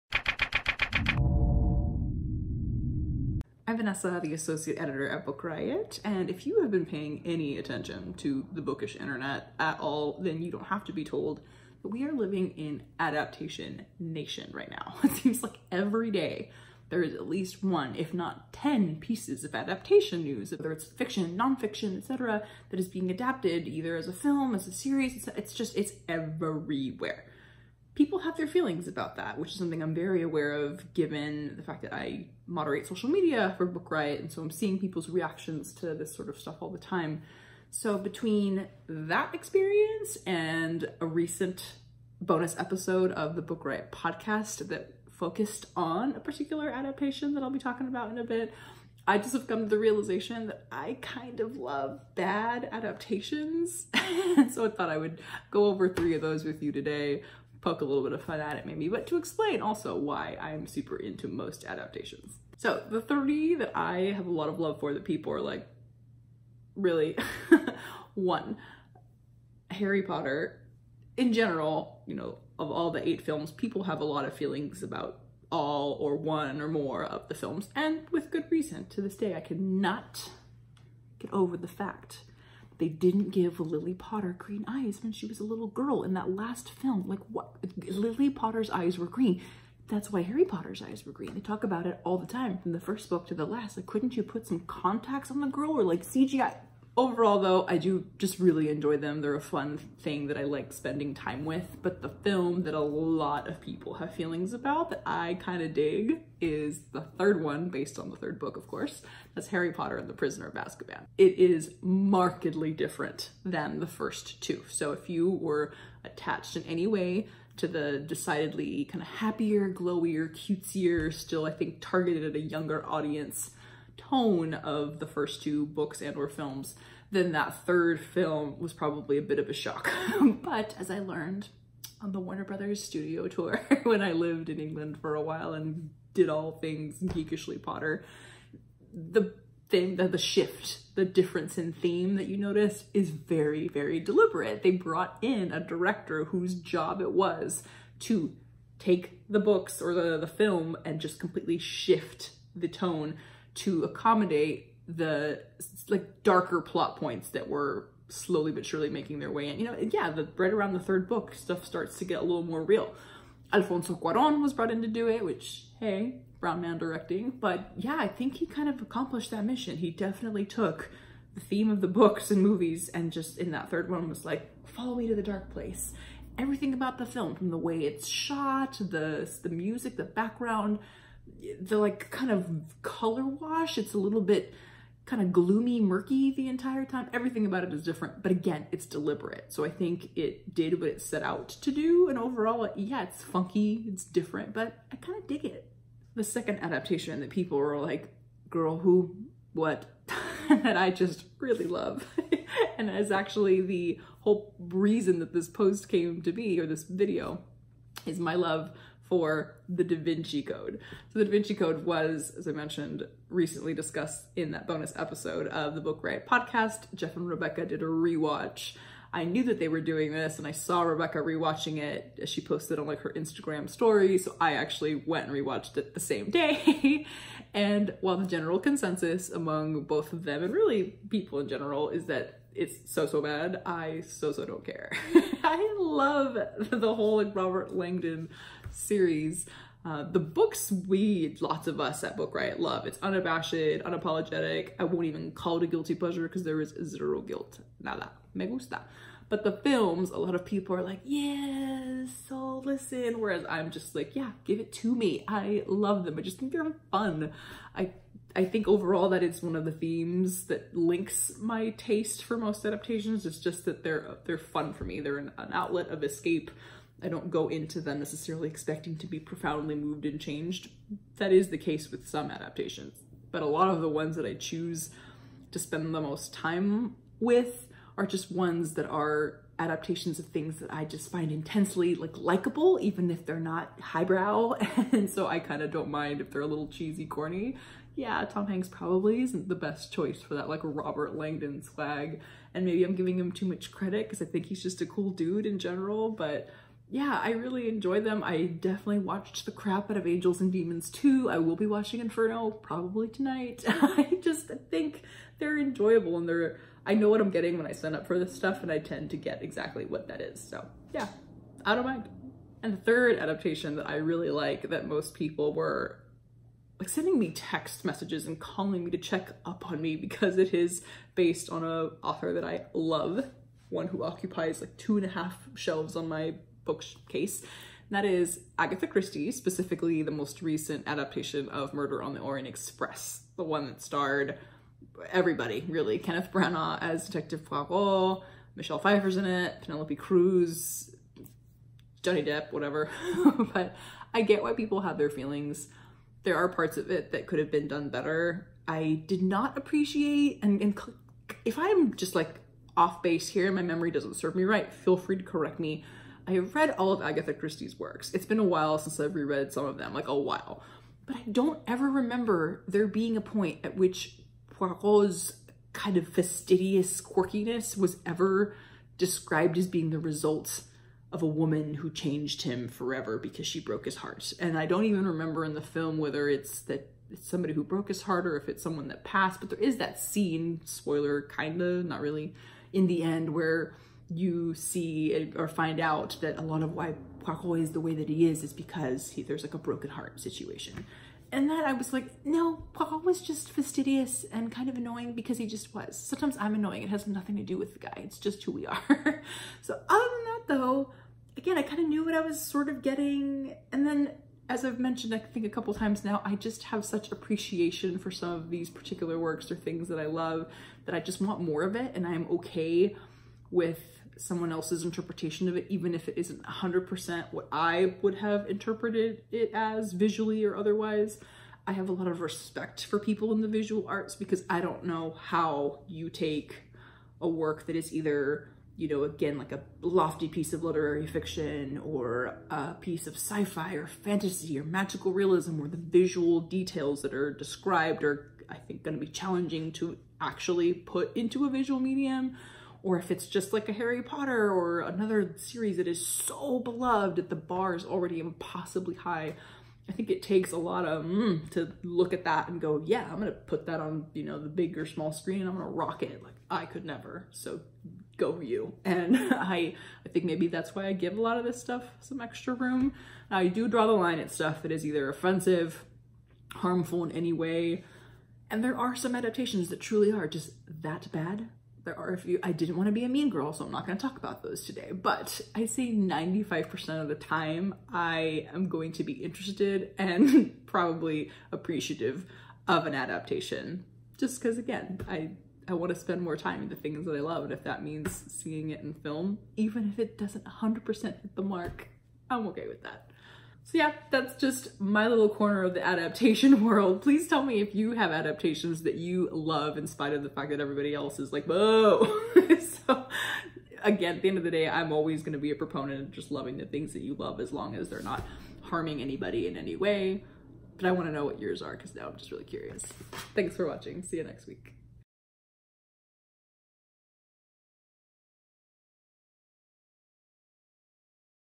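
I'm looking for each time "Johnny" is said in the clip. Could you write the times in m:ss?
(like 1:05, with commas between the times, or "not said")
5:42.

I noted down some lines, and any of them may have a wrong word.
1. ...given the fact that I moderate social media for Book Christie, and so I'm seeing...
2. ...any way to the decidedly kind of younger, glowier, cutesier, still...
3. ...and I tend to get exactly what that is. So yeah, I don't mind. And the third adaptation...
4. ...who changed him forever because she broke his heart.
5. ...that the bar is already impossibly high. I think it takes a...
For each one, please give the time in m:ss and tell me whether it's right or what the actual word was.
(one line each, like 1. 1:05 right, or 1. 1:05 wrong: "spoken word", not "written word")
1. 0:30 wrong: "Riot", not "Christie"
2. 1:56 wrong: "happier", not "younger"
3. 5:08 right
4. 6:11 right
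5. 7:27 right.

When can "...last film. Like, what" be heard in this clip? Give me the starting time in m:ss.
1:26.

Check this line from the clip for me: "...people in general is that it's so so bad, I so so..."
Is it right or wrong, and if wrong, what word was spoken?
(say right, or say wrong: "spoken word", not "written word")
right.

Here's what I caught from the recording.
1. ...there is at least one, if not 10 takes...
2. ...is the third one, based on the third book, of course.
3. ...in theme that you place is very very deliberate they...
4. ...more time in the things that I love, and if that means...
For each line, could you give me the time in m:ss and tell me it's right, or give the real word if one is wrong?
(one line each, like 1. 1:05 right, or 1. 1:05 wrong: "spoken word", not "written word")
1. 0:16 wrong: "pieces", not "takes"
2. 1:46 right
3. 2:21 wrong: "notice", not "place"
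4. 8:06 right.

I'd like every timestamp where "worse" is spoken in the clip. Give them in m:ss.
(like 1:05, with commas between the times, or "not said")
not said.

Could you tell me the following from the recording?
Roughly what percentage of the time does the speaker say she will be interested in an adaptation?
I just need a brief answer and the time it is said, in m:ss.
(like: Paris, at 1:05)
95%, at 7:55.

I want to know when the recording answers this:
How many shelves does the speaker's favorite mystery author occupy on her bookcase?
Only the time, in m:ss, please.
5:24.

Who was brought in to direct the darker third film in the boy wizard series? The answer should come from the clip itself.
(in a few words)
Alfonso Cuaron.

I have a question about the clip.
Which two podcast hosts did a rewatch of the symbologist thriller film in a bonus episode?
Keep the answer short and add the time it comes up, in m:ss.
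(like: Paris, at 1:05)
Jeff and Rebecca, at 3:36.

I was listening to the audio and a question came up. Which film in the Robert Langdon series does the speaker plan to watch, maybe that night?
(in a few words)
Inferno.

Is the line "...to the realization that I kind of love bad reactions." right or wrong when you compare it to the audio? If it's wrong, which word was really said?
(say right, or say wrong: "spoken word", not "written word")
wrong: "adaptations", not "reactions".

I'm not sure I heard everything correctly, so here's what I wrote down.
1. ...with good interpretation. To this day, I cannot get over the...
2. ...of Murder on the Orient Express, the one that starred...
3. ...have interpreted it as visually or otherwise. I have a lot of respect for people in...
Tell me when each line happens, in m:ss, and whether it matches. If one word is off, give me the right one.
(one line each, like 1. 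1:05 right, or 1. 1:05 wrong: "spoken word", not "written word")
1. 1:18 wrong: "reason", not "interpretation"
2. 5:31 right
3. 6:58 right.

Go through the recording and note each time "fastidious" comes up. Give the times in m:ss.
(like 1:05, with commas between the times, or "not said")
6:06, 6:33.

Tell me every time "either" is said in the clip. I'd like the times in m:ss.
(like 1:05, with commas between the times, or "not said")
0:23, 7:07, 7:44.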